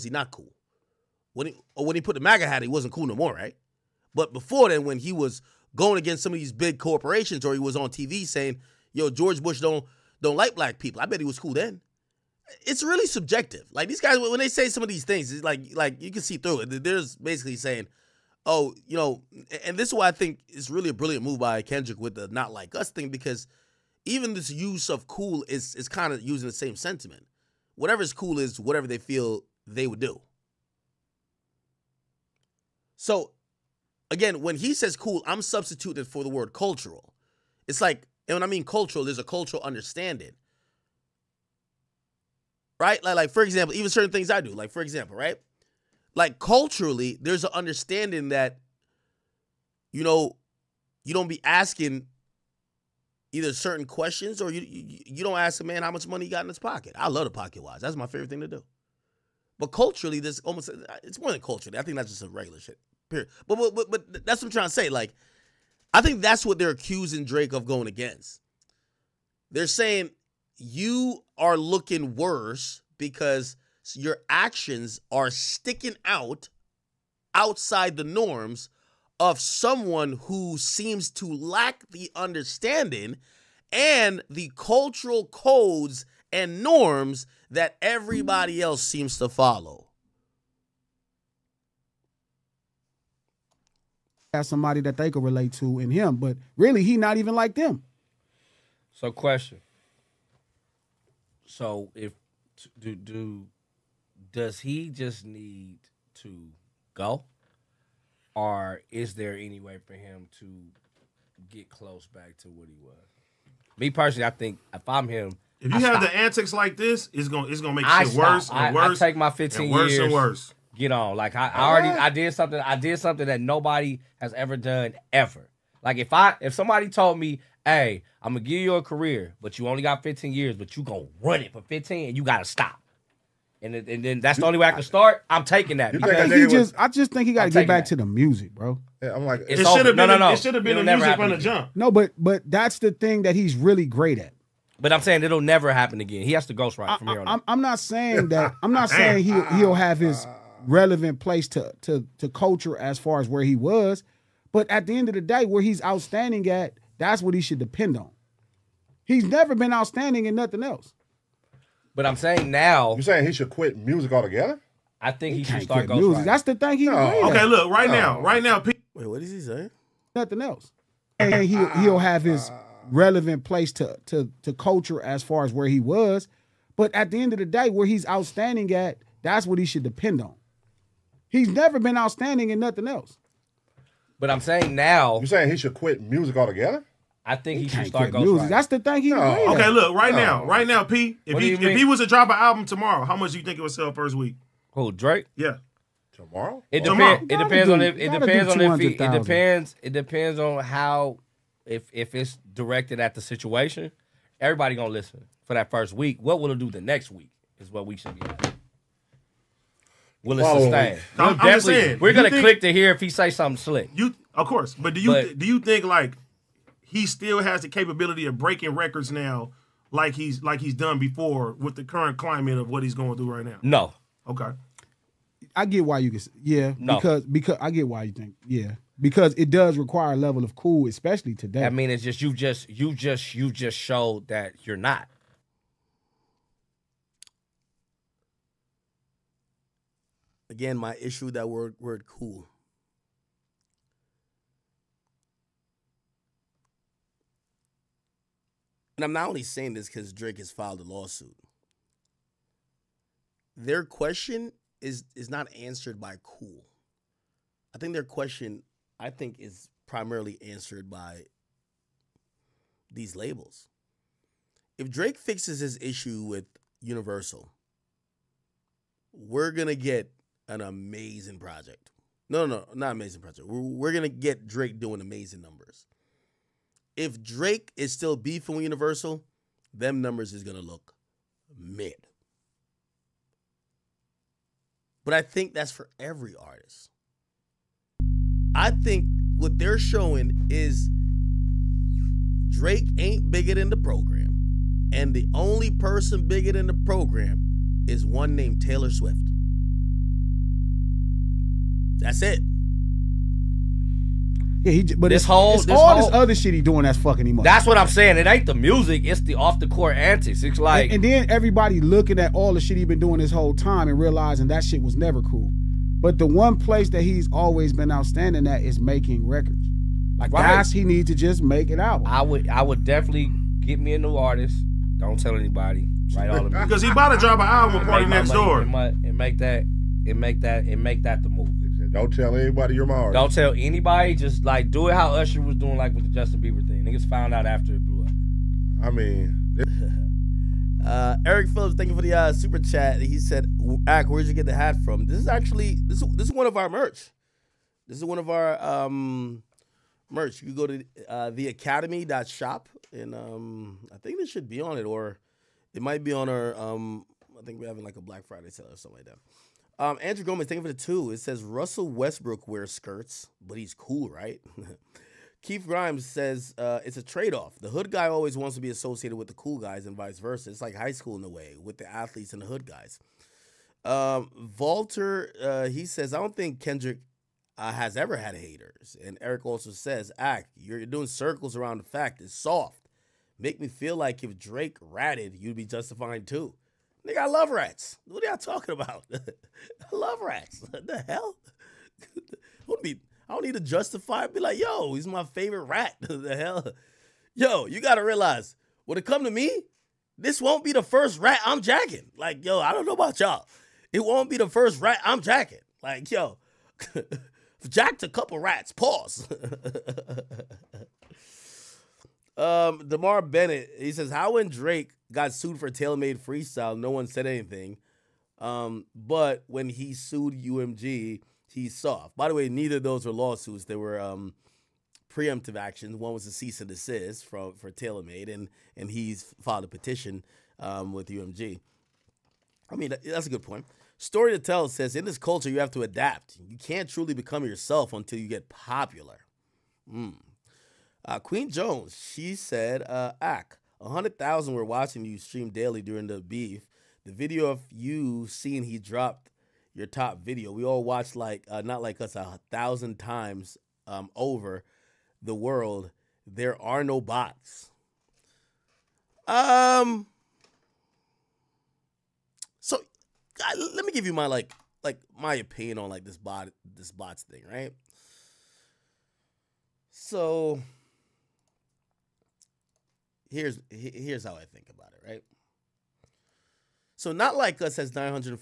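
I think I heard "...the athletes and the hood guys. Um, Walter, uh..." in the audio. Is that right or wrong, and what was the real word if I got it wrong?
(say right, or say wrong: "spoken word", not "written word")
right.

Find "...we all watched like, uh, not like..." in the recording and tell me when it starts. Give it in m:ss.
7:30.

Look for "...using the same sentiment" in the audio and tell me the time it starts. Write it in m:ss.
0:26.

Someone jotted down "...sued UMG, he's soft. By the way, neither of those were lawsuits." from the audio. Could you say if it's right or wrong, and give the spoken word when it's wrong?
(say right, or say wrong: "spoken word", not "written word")
right.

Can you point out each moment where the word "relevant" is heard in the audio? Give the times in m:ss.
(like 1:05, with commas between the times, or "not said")
2:30, 2:52.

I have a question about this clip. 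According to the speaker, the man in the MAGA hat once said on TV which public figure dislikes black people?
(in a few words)
George Bush.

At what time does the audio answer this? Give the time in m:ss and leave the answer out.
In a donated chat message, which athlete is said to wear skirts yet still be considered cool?
6:01.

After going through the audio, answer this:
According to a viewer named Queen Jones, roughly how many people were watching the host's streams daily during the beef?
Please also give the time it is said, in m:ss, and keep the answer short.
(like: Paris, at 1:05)
100,000, at 7:23.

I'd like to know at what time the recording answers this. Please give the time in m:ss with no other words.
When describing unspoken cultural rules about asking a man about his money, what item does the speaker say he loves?
0:57.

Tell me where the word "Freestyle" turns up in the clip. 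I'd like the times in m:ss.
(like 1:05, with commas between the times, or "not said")
6:56.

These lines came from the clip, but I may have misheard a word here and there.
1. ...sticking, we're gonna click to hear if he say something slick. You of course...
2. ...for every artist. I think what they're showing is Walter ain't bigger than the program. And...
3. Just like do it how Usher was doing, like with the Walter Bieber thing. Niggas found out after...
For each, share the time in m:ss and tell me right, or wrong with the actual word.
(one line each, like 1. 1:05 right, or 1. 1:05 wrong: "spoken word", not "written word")
1. 3:31 wrong: "saying", not "sticking"
2. 4:45 wrong: "Drake", not "Walter"
3. 5:34 wrong: "Justin", not "Walter".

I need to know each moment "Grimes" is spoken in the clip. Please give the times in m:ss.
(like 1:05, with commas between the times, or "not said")
6:05.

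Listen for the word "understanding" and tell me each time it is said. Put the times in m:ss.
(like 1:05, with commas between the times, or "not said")
0:39, 0:47, 1:22.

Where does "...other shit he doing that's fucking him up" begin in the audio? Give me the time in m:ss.
5:06.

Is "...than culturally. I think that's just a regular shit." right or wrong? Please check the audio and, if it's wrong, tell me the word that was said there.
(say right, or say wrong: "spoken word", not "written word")
right.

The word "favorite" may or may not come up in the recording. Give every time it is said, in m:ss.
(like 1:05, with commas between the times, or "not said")
0:58, 6:35.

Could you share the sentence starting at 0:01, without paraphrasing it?
When he, when he put the MAGA hat, he wasn't cool no more, right?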